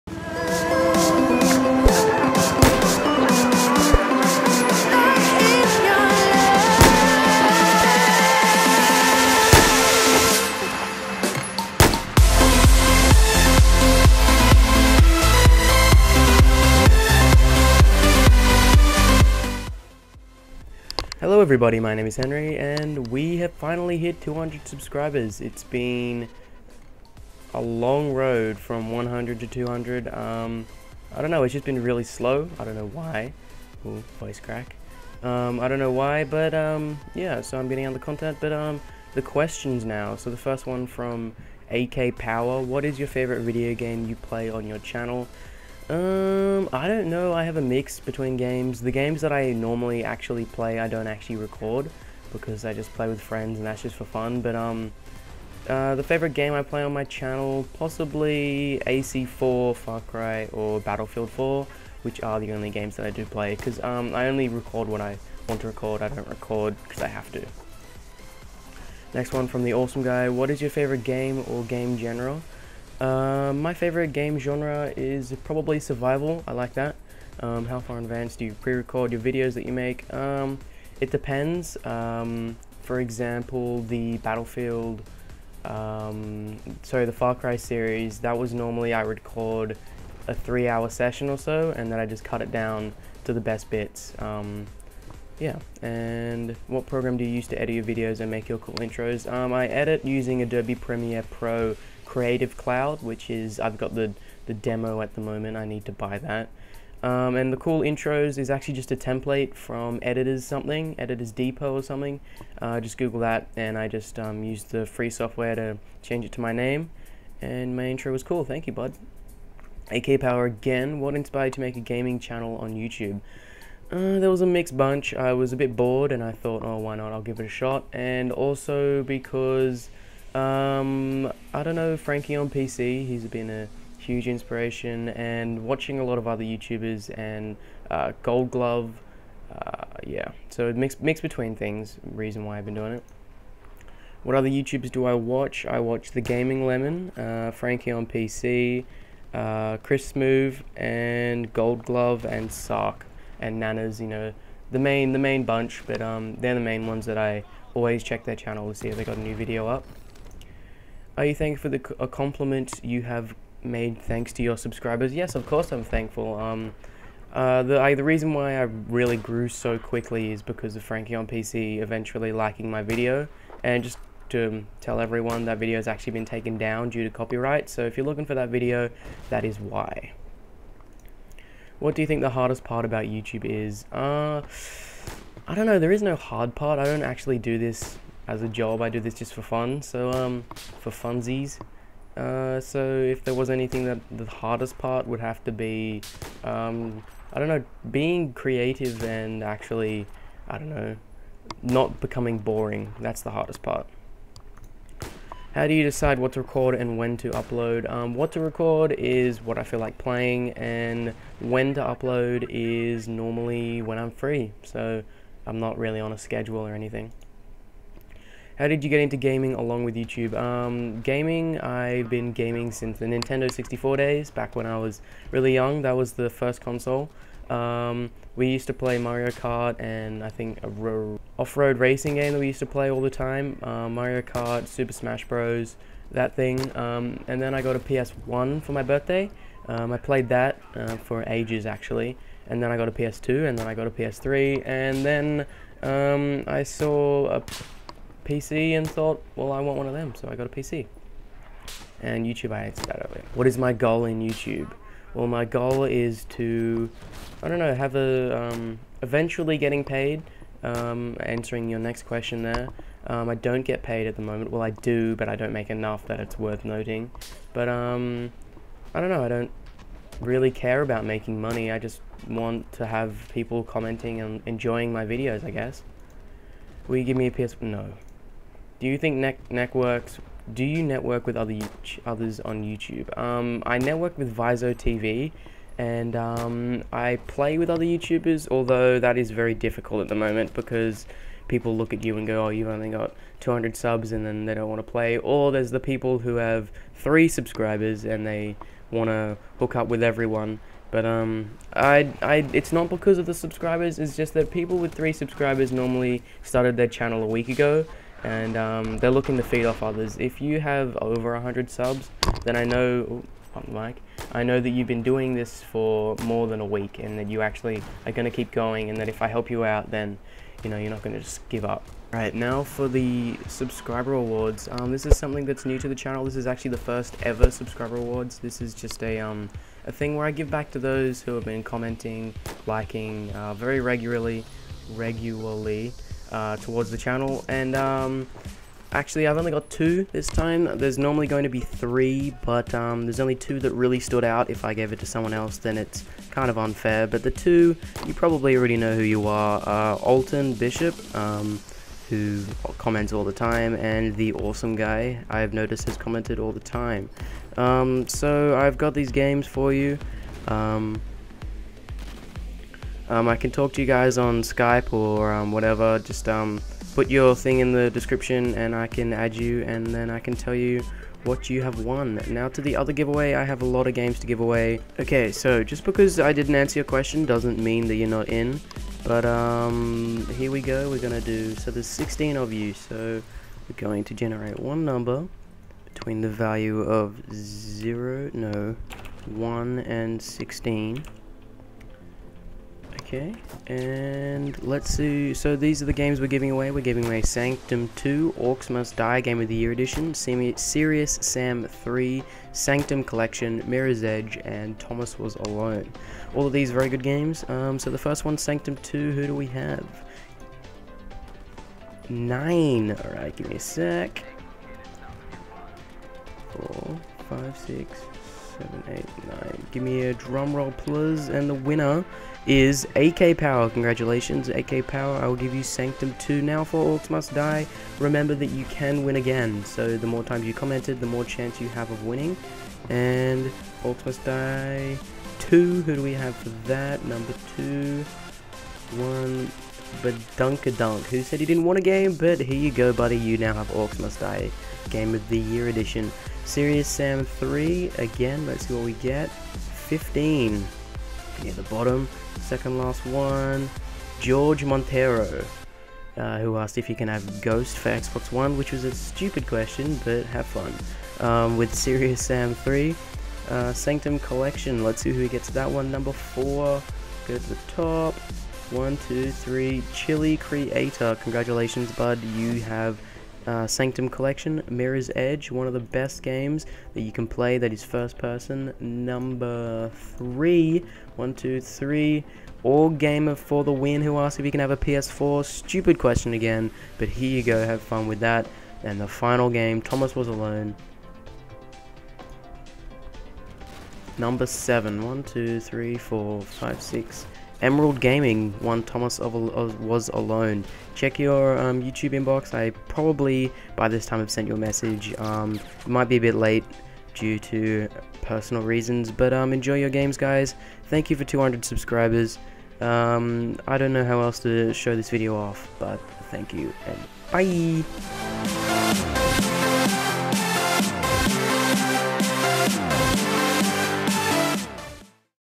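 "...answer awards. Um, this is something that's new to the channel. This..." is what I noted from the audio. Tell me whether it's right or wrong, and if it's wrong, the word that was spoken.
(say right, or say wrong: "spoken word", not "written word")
wrong: "subscriber", not "answer".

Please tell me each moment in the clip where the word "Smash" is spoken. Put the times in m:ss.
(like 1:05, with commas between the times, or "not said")
3:54.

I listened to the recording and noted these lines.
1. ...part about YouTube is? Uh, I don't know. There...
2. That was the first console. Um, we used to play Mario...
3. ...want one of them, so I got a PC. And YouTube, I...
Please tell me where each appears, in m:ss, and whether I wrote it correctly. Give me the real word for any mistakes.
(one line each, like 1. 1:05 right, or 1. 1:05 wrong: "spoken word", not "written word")
1. 3:02 right
2. 3:45 right
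3. 4:09 right.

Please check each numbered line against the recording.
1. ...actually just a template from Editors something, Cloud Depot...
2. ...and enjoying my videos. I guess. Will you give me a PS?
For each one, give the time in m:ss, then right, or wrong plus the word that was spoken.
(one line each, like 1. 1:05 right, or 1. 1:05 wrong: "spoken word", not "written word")
1. 1:48 wrong: "Editors", not "Cloud"
2. 4:34 right.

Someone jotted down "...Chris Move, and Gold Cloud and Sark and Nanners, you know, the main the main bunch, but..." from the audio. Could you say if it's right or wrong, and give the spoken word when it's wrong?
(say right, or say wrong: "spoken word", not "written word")
wrong: "Glove", not "Cloud".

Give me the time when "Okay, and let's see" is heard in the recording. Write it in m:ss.
6:33.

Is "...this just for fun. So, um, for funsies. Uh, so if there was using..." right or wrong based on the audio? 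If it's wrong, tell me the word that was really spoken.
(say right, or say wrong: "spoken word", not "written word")
wrong: "anything", not "using".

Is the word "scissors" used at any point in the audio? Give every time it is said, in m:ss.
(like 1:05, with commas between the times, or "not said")
not said.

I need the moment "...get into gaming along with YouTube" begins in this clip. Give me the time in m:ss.
3:38.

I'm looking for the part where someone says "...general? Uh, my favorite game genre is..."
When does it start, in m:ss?
1:11.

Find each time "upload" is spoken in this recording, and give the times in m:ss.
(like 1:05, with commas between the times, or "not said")
3:27, 3:31.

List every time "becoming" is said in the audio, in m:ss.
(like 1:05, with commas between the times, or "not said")
3:21.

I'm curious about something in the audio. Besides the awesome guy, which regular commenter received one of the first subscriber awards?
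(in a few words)
Alton Bishop.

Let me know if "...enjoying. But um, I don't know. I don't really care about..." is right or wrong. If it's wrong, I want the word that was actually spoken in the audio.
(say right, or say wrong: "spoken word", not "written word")
wrong: "noting", not "enjoying".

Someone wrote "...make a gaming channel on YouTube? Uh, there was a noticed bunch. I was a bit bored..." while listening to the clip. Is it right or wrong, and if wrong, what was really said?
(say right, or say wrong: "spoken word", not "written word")
wrong: "mixed", not "noticed".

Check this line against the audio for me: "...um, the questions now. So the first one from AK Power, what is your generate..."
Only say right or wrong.
wrong.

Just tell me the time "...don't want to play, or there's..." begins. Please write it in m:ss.
4:54.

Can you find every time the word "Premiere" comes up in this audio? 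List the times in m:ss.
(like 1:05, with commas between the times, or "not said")
1:40.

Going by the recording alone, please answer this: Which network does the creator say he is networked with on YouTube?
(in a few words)
Viso TV.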